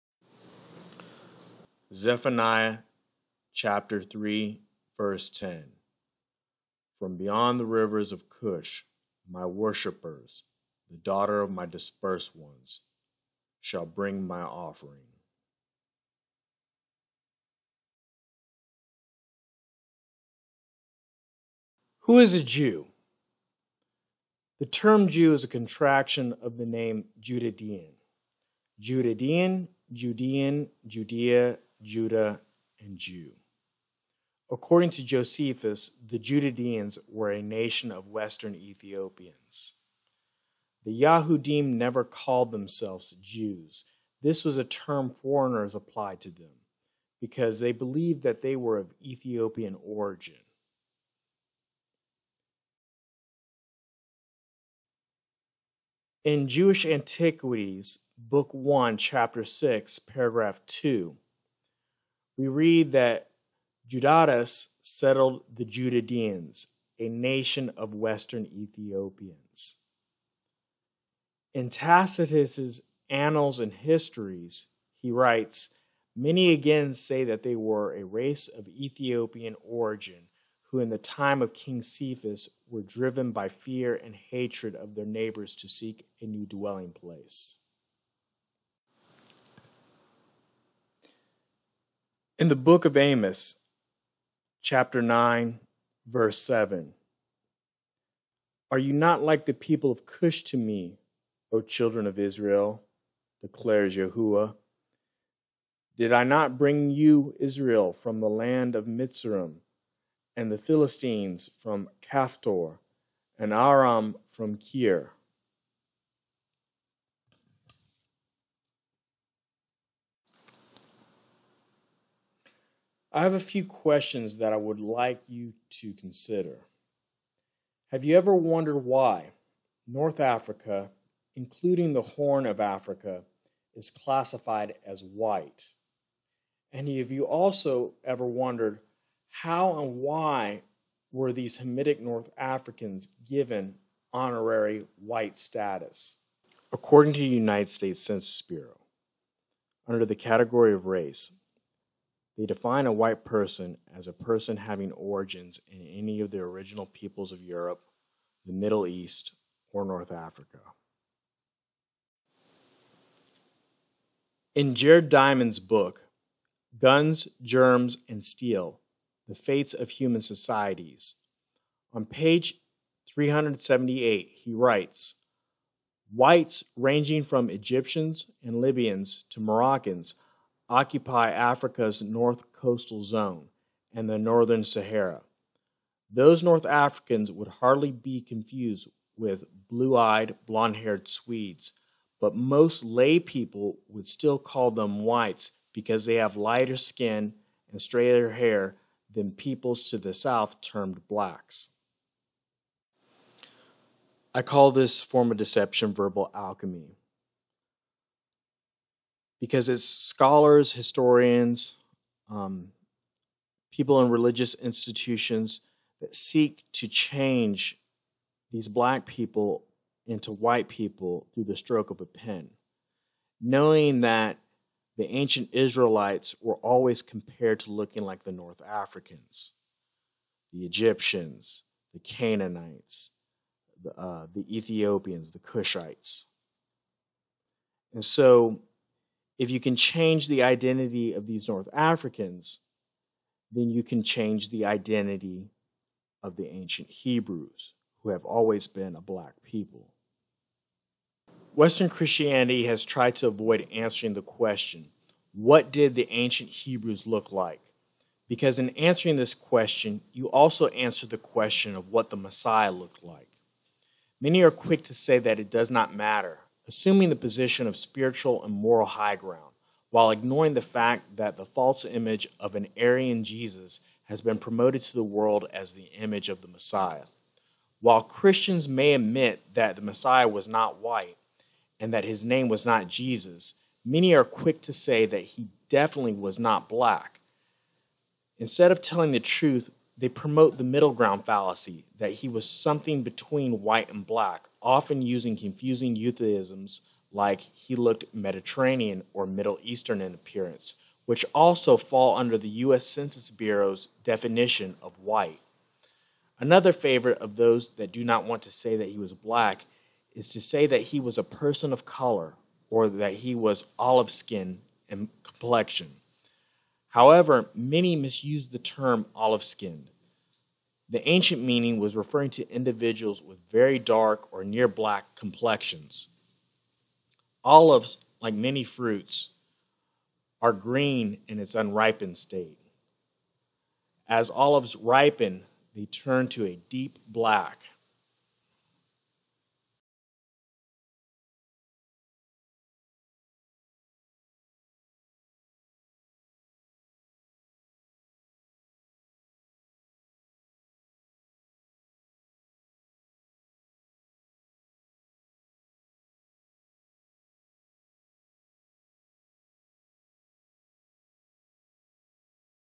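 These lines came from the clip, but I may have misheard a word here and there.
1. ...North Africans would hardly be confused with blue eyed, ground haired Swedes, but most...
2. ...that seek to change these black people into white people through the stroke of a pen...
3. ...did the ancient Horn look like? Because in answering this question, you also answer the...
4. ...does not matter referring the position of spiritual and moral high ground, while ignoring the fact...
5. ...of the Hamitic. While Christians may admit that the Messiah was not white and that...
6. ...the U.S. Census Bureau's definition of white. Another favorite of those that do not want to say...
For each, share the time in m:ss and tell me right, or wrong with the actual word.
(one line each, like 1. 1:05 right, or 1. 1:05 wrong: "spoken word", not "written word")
1. 3:06 wrong: "blond", not "ground"
2. 3:35 right
3. 4:15 wrong: "Hebrews", not "Horn"
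4. 4:25 wrong: "assuming", not "referring"
5. 4:36 wrong: "Messiah", not "Hamitic"
6. 5:02 right.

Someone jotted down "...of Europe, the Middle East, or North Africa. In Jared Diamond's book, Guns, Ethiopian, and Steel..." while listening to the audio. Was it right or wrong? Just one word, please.
wrong.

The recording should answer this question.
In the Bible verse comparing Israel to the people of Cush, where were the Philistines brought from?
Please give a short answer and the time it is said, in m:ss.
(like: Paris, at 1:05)
Kaphtor, at 1:52.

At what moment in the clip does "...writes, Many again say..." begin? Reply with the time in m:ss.
1:15.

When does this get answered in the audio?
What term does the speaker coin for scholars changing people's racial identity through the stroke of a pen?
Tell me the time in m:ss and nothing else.
3:25.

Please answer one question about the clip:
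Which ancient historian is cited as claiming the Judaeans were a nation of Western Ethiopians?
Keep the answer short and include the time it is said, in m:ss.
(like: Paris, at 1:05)
Josephus, at 0:35.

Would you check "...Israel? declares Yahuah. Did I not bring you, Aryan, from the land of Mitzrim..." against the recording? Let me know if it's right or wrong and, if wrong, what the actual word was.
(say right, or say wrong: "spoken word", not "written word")
wrong: "Israel", not "Aryan".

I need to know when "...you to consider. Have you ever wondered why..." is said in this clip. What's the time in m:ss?
2:05.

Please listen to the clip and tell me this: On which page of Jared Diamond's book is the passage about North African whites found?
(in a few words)
378.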